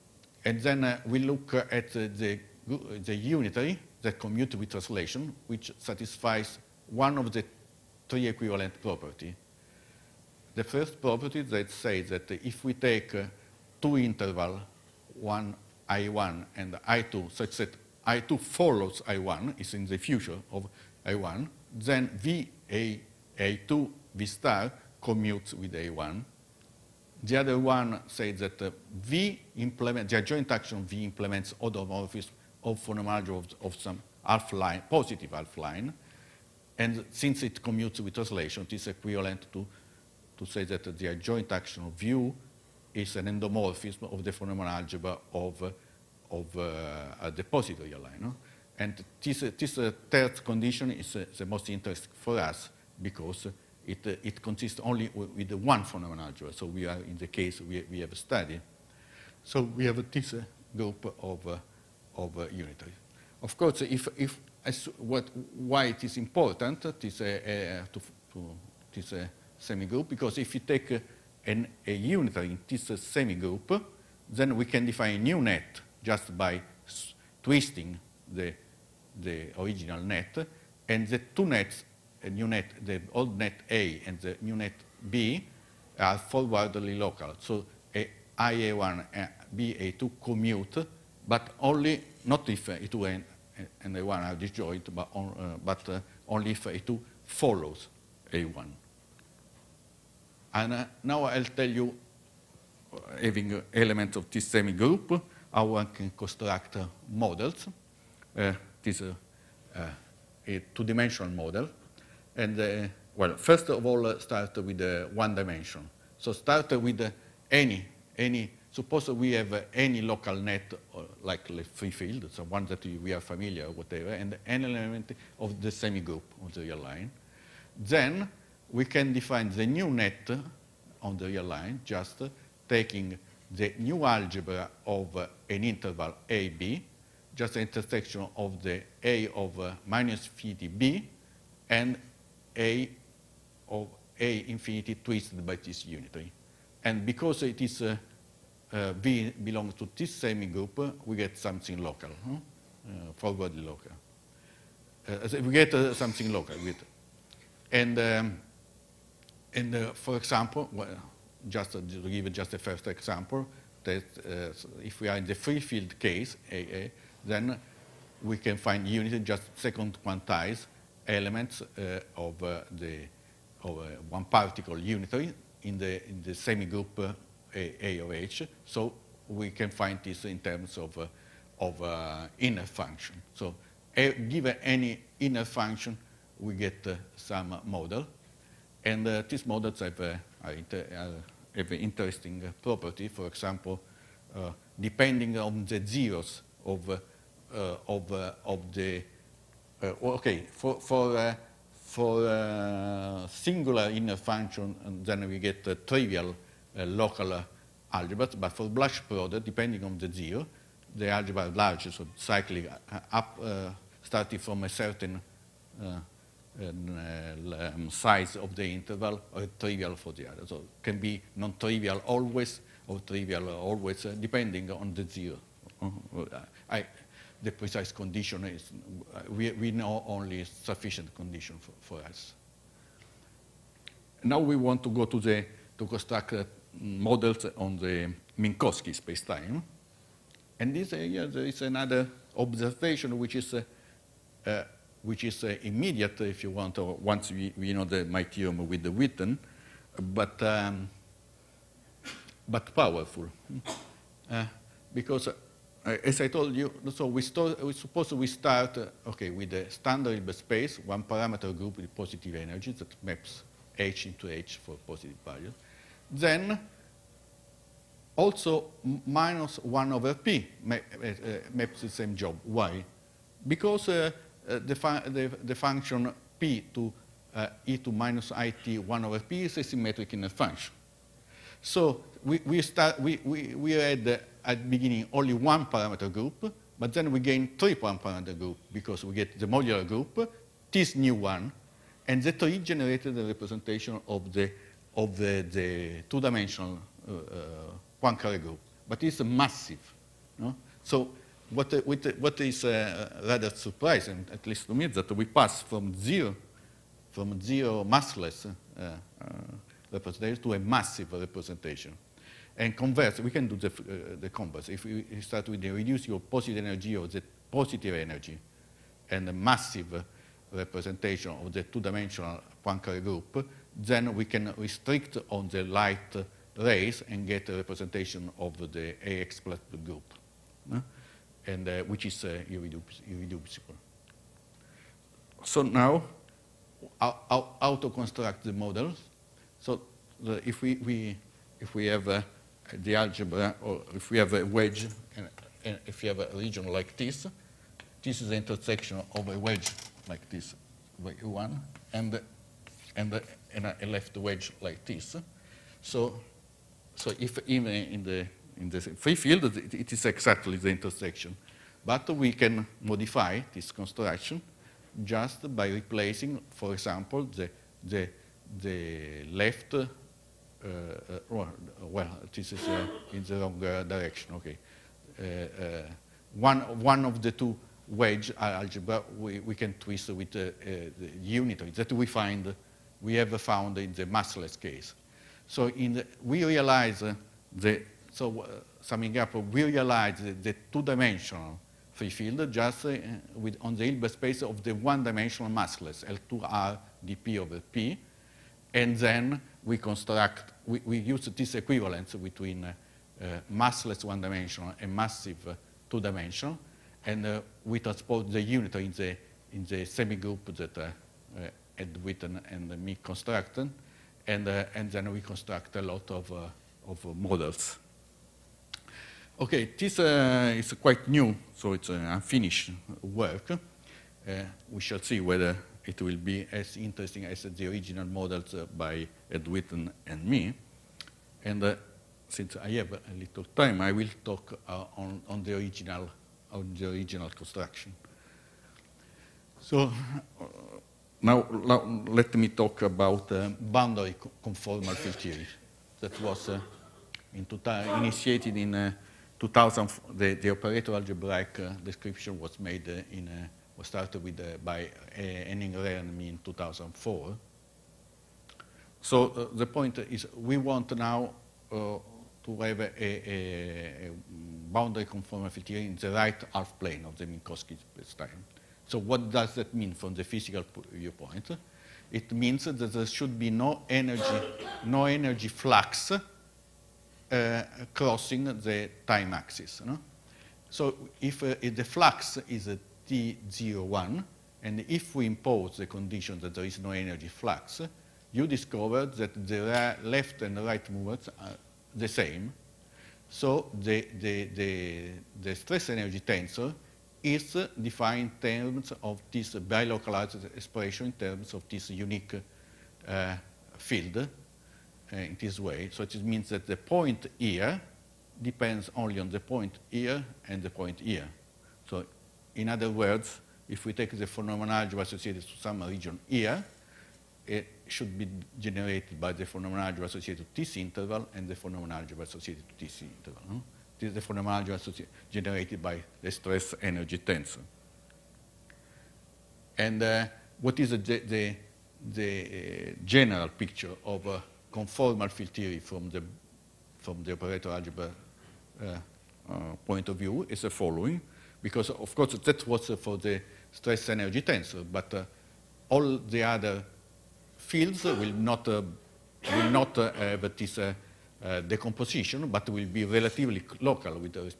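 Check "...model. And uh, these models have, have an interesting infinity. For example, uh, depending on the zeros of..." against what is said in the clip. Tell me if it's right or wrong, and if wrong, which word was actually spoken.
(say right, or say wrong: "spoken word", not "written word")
wrong: "property", not "infinity".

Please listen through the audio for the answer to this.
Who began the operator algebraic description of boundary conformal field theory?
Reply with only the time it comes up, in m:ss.
7:35.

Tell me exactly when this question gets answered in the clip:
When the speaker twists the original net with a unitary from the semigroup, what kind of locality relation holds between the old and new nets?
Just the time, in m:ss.
1:26.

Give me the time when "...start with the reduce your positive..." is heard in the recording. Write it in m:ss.
5:15.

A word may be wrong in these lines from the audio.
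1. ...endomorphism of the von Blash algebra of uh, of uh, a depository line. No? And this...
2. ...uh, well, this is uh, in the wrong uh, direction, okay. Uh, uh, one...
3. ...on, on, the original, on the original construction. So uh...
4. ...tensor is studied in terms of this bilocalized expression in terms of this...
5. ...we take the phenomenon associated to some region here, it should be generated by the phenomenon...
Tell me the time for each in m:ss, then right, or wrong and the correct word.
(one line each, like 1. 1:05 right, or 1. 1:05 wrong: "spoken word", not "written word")
1. 0:43 wrong: "Neumann", not "Blash"
2. 6:10 right
3. 7:14 right
4. 8:16 wrong: "defined", not "studied"
5. 8:33 right.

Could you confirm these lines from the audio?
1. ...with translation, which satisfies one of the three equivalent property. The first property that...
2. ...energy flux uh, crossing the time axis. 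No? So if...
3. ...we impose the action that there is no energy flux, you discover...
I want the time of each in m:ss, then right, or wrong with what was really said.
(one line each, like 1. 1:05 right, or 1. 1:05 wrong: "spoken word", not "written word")
1. 0:04 right
2. 7:55 right
3. 8:05 wrong: "condition", not "action".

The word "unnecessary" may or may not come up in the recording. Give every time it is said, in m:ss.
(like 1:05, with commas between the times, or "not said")
not said.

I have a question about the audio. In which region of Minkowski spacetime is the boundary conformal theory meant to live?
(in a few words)
Right half plane.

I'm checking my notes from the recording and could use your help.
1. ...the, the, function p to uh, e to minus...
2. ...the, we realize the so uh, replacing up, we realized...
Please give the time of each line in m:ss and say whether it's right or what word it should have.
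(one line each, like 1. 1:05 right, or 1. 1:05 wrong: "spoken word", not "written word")
1. 4:35 right
2. 6:25 wrong: "summing", not "replacing".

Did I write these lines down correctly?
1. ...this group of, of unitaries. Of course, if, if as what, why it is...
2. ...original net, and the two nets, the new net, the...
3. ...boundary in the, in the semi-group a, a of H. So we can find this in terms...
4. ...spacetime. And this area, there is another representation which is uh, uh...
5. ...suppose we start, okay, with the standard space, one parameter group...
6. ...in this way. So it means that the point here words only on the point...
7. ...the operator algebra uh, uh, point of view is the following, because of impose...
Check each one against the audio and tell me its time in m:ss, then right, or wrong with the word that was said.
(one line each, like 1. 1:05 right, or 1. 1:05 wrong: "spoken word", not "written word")
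1. 1:00 right
2. 1:19 right
3. 2:54 wrong: "unitary", not "boundary"
4. 3:58 wrong: "observation", not "representation"
5. 4:17 right
6. 8:25 wrong: "depends", not "words"
7. 8:57 wrong: "course", not "impose".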